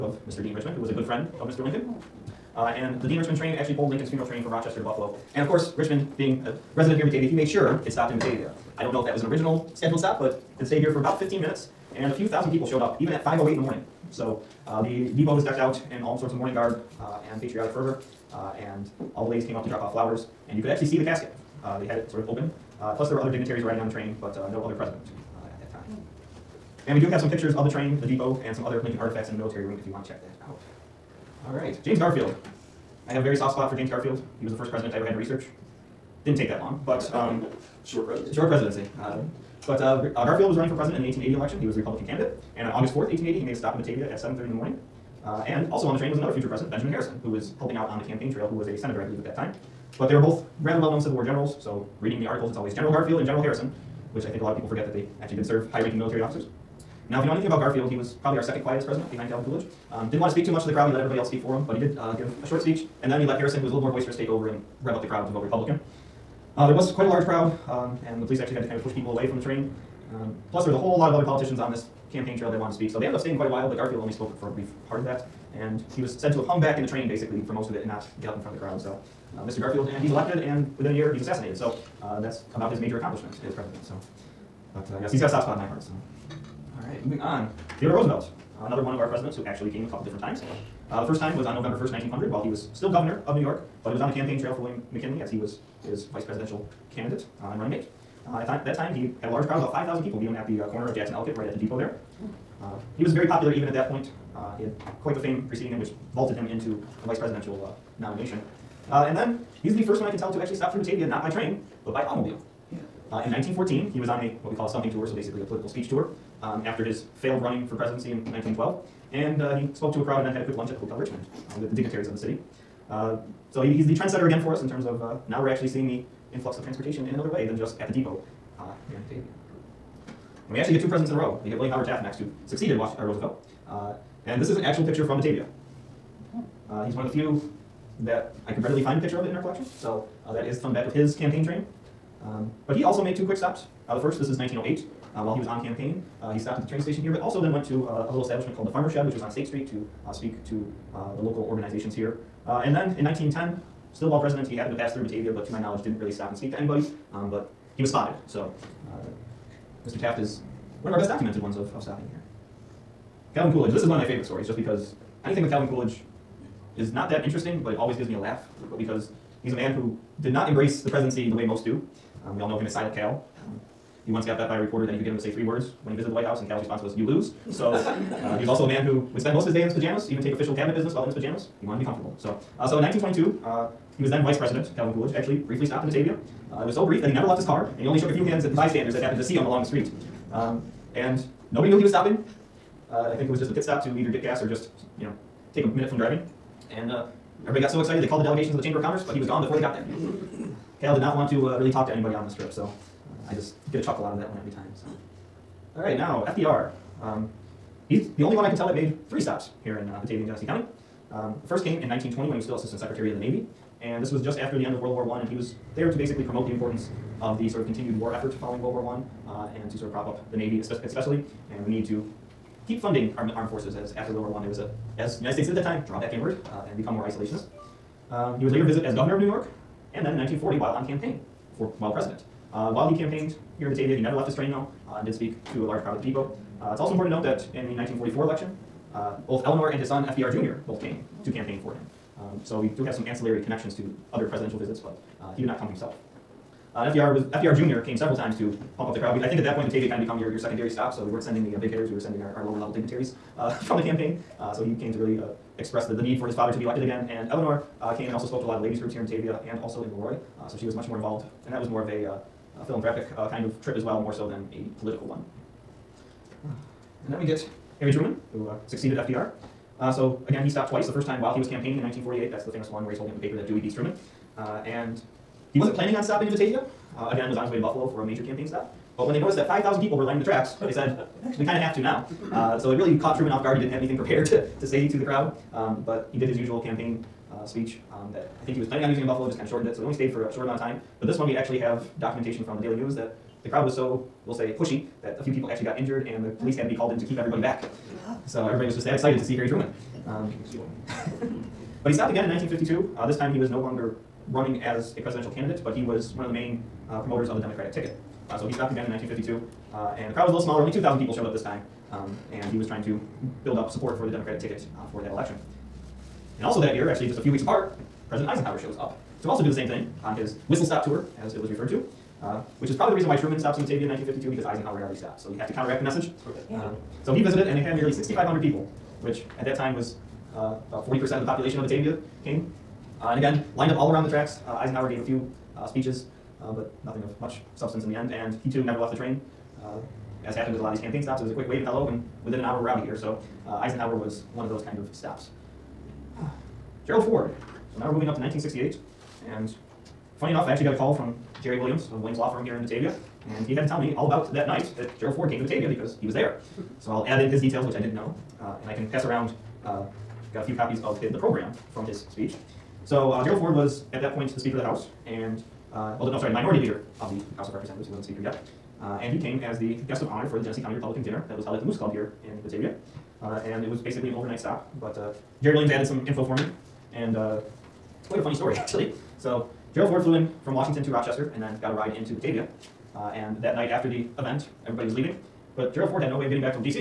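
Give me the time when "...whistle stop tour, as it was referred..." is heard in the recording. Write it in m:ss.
5:20.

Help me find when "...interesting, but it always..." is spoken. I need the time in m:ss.
2:47.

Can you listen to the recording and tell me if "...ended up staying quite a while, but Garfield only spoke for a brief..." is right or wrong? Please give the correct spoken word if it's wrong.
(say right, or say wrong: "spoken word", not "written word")
right.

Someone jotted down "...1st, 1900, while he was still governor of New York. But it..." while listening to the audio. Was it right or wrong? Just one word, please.
right.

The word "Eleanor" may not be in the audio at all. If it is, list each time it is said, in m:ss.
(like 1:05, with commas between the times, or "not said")
3:59, 4:17.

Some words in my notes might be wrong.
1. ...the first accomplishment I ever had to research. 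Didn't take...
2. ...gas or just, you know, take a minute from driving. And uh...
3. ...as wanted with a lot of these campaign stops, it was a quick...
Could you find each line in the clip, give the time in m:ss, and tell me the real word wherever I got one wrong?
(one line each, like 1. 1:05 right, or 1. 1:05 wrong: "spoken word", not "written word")
1. 0:34 wrong: "president", not "accomplishment"
2. 3:14 right
3. 5:40 wrong: "happened", not "wanted".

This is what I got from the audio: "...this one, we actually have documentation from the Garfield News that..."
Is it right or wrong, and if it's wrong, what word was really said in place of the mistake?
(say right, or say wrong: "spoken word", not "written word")
wrong: "Daily", not "Garfield".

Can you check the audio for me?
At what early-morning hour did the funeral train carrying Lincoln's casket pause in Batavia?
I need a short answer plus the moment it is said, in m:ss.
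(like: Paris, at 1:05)
5:08, at 0:13.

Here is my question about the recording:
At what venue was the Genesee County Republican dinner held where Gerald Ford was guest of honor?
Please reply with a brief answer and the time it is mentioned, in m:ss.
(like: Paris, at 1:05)
Moose Club, at 6:11.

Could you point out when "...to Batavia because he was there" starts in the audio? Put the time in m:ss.
5:55.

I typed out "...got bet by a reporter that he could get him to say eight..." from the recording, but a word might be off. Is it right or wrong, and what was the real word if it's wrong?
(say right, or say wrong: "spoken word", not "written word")
wrong: "three", not "eight".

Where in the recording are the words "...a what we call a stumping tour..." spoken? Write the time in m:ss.
1:54.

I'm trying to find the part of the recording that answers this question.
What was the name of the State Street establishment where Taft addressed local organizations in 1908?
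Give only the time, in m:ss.
2:28.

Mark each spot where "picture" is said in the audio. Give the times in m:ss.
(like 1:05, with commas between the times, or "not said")
0:27, 2:14, 2:19.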